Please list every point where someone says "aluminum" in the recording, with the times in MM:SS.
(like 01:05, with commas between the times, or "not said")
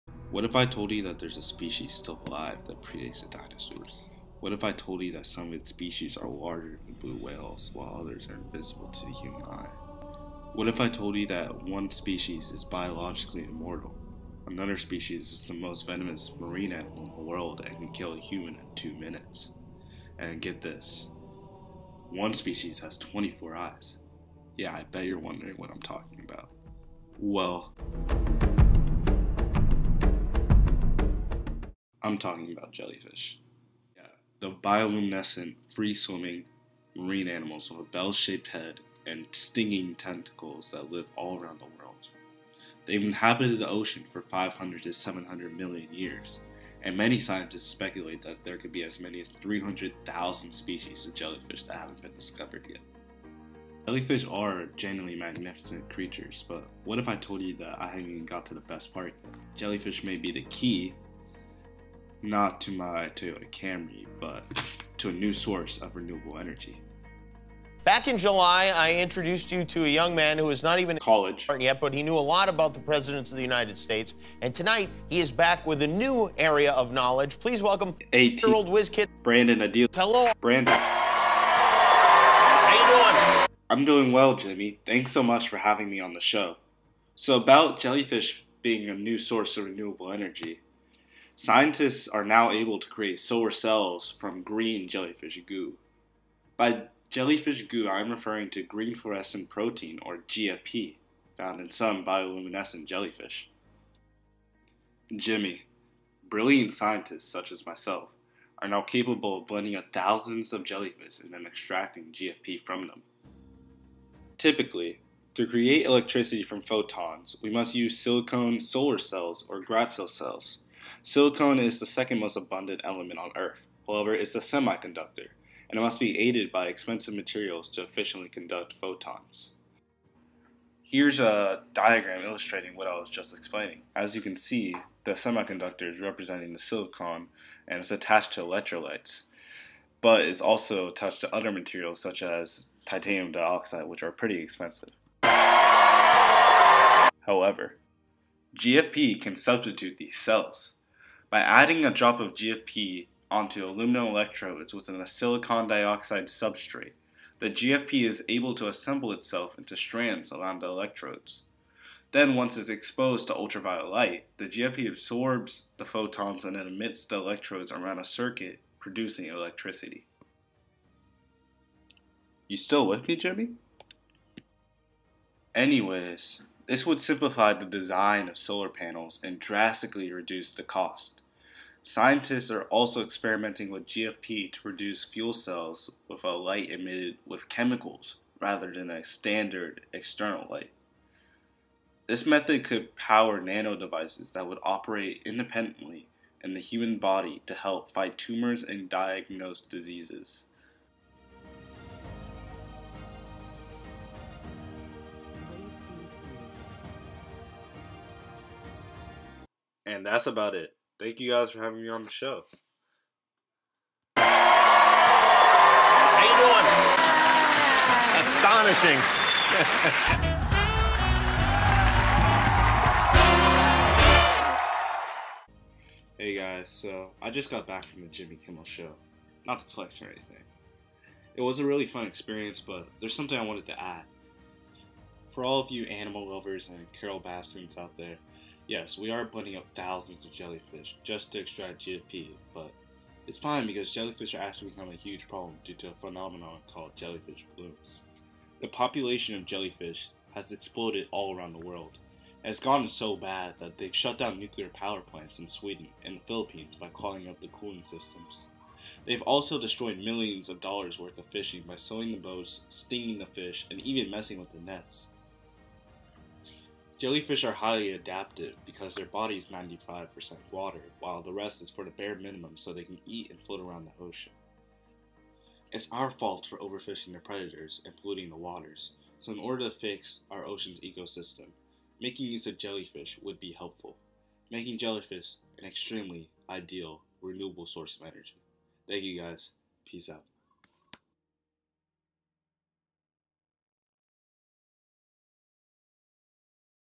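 02:33.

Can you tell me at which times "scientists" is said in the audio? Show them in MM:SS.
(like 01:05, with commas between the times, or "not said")
00:47, 01:31, 01:46, 03:01.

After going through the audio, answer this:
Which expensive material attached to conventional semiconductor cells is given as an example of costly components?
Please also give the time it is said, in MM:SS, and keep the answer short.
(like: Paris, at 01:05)
titanium dioxide, at 02:22.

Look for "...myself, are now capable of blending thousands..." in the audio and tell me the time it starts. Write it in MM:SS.
01:47.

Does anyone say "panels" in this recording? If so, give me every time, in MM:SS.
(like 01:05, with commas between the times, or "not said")
02:58.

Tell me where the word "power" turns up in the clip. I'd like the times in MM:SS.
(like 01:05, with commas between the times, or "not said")
03:12, 04:14.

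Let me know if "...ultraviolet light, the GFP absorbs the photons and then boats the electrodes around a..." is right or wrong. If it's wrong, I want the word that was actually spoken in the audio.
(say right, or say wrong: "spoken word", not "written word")
wrong: "emits", not "boats".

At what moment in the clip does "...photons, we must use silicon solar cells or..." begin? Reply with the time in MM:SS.
01:56.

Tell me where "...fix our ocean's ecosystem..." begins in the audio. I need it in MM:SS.
04:39.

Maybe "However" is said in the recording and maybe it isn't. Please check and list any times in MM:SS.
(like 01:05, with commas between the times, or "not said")
02:03, 02:25.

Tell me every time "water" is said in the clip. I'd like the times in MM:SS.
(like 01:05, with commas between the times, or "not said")
04:30, 04:38.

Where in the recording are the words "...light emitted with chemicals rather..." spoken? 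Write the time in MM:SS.
03:06.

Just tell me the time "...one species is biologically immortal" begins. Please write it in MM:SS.
00:11.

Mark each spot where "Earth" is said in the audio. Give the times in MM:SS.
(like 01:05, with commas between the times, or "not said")
02:03.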